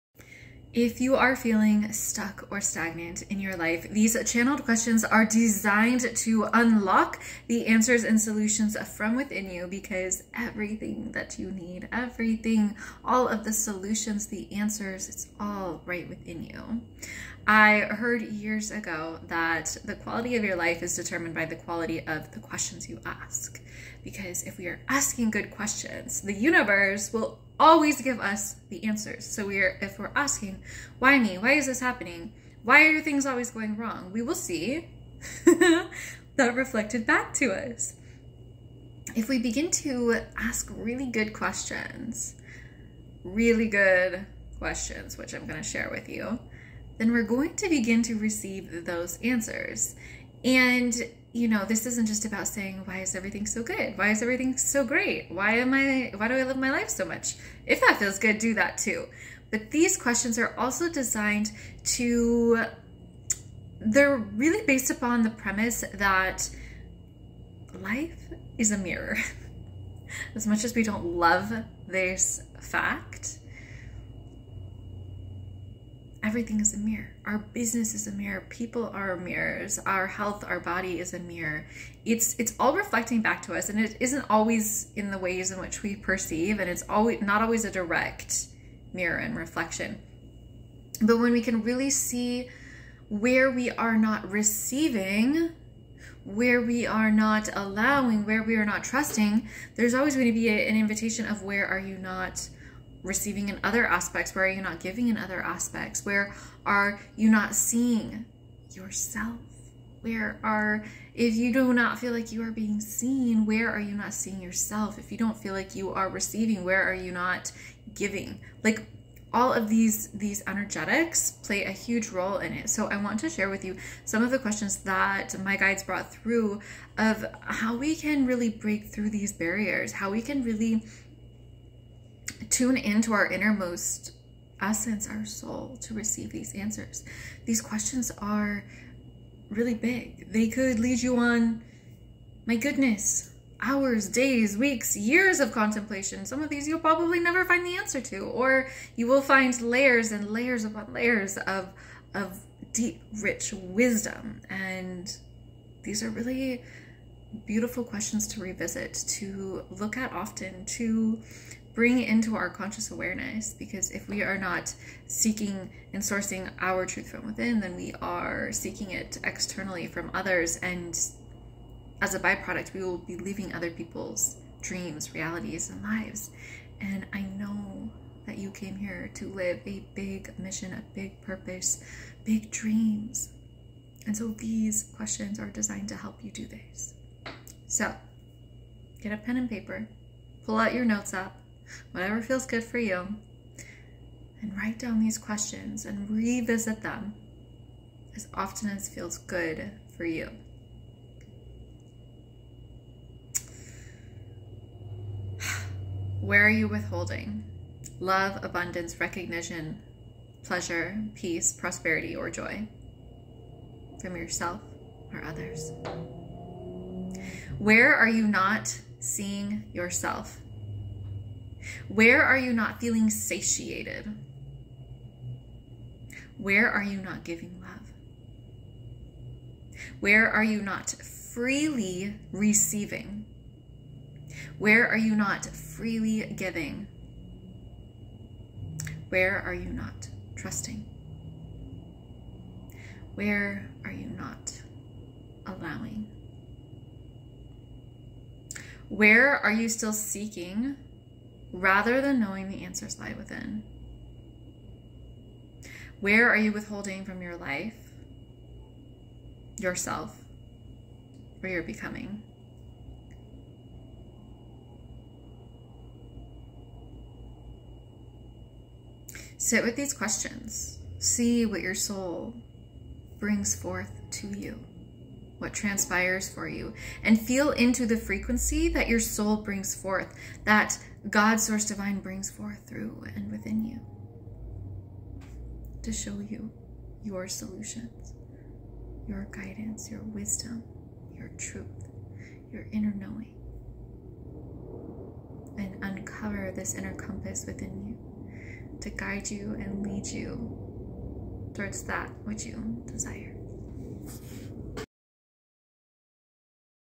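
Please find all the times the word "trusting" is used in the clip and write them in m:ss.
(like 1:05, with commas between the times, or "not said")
1:38, 4:00.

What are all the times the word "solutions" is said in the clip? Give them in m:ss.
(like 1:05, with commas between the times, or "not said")
0:08, 0:13, 4:47.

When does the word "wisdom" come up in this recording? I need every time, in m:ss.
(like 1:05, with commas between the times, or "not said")
2:33, 4:50.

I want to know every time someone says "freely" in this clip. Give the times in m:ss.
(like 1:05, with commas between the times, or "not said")
3:50, 3:55.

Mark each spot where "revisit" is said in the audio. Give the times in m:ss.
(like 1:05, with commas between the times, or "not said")
2:38, 3:16.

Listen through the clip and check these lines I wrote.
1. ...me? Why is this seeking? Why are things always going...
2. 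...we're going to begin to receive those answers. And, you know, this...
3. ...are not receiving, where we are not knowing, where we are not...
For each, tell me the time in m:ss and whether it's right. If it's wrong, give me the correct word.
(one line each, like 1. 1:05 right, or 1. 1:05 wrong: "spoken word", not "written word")
1. 0:31 wrong: "happening", not "seeking"
2. 0:47 right
3. 1:33 wrong: "allowing", not "knowing".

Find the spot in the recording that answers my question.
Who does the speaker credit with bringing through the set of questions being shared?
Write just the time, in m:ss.
2:05.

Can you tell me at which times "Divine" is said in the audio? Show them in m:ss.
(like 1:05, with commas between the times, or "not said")
4:41.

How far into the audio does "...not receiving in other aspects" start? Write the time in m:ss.
1:41.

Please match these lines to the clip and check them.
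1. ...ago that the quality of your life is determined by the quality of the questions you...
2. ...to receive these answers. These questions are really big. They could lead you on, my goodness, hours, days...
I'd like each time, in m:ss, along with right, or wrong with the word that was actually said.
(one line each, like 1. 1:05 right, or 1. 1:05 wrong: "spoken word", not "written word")
1. 0:18 right
2. 2:15 right.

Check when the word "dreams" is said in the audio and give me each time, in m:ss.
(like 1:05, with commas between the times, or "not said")
2:54, 3:02.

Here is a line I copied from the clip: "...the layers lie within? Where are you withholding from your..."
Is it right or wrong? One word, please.
wrong.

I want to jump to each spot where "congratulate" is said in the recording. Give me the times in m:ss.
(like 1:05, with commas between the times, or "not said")
not said.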